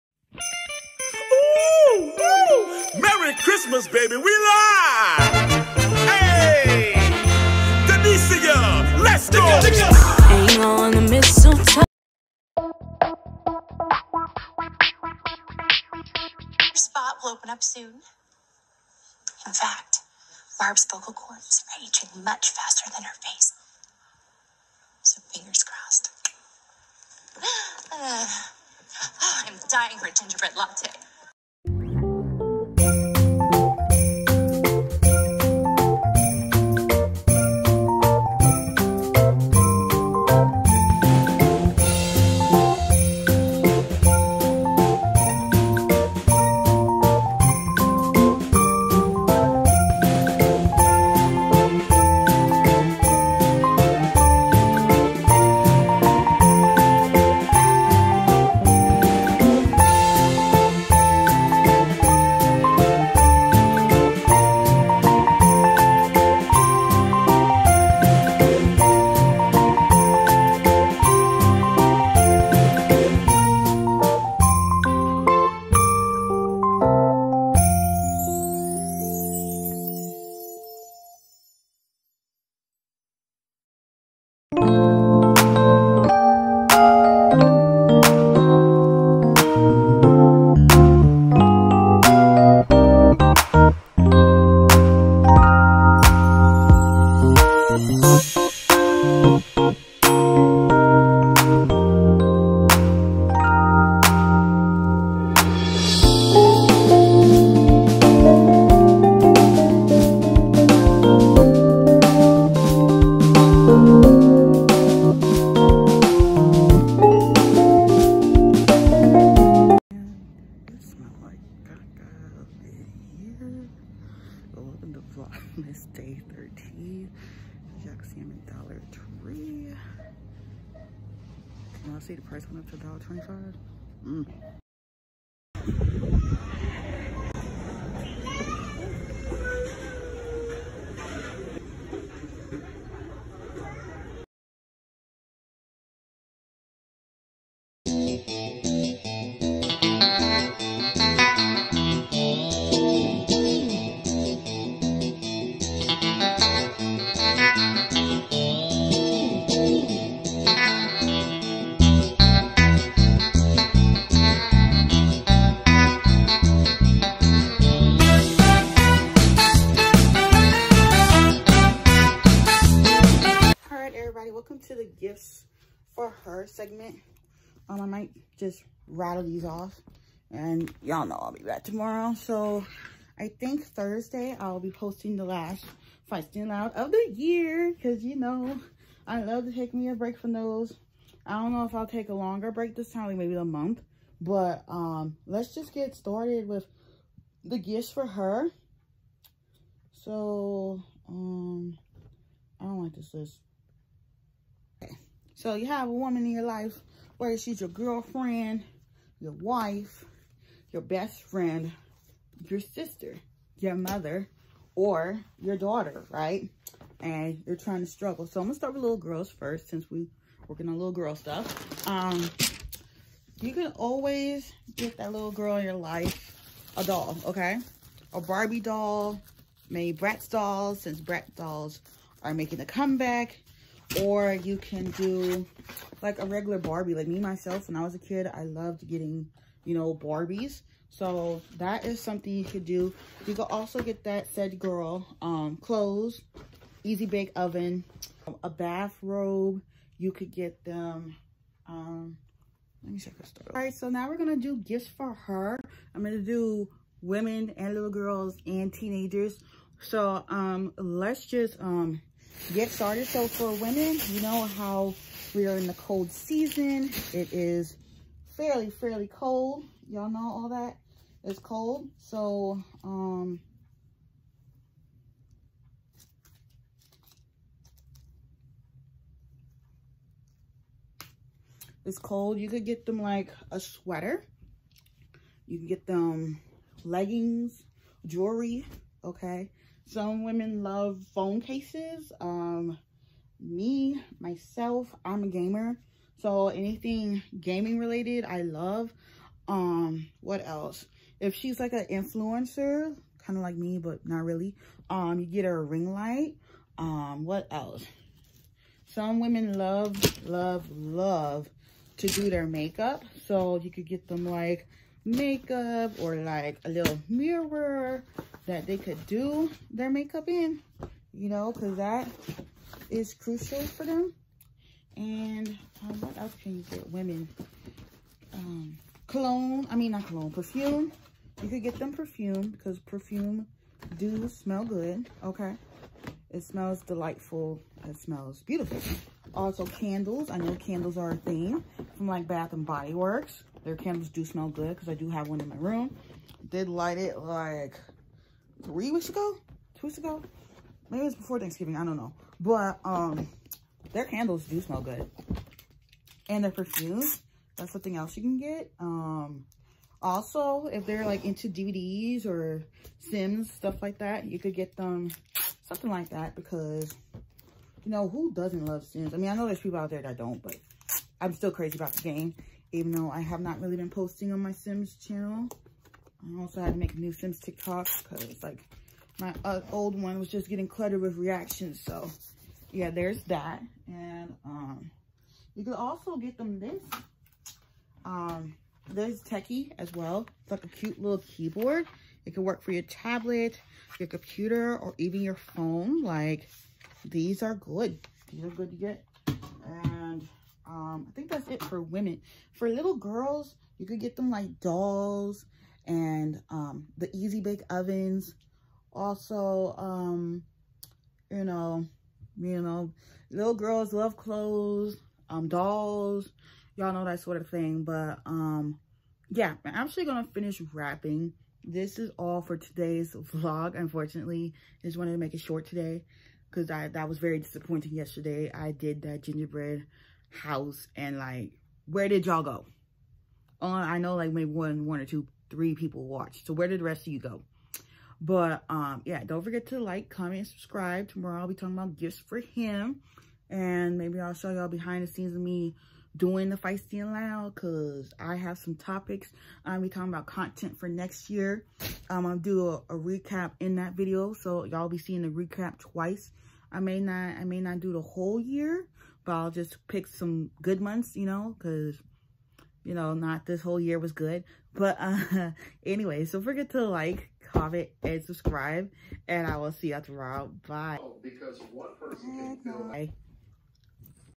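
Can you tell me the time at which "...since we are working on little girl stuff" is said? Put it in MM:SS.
03:39.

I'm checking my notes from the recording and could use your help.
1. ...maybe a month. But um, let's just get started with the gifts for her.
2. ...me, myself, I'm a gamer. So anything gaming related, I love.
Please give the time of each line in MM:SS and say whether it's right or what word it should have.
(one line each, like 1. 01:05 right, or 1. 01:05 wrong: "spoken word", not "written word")
1. 03:13 right
2. 04:53 right.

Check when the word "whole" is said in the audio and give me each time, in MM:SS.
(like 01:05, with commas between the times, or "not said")
07:38, 07:43.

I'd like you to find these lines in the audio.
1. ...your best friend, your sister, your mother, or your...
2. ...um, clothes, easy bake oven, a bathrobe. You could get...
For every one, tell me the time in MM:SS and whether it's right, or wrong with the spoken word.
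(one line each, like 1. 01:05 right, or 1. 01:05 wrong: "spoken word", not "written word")
1. 03:30 right
2. 04:05 right.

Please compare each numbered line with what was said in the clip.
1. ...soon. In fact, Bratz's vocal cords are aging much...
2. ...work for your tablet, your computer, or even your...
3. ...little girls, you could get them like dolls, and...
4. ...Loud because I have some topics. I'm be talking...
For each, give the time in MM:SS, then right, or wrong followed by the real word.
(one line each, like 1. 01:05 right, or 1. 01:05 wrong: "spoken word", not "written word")
1. 00:17 wrong: "Barb", not "Bratz"
2. 06:32 right
3. 06:42 right
4. 07:27 right.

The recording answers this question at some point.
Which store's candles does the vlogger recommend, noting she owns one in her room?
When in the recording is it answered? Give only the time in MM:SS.
05:42.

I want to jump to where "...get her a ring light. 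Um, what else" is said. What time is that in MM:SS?
05:05.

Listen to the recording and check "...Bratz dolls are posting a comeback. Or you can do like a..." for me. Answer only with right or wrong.
wrong.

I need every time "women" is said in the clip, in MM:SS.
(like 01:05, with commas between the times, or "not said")
04:17, 04:23, 04:50, 05:09, 05:26, 06:41.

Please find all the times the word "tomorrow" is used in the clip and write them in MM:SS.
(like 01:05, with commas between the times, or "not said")
03:01, 07:21, 07:50.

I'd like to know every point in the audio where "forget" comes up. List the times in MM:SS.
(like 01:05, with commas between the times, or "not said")
07:19, 07:46.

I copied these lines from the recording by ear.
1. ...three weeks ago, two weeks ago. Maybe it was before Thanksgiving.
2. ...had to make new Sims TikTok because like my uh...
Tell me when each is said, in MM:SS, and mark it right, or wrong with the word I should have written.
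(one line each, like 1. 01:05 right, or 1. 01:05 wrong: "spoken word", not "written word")
1. 05:48 right
2. 06:16 right.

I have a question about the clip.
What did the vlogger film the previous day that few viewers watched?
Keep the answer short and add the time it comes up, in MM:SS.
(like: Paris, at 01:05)
Gingerbread house, at 07:09.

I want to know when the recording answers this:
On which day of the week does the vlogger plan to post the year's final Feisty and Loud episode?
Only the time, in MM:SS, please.
03:03.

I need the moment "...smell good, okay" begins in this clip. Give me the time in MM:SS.
05:34.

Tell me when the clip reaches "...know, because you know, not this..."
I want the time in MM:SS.
07:41.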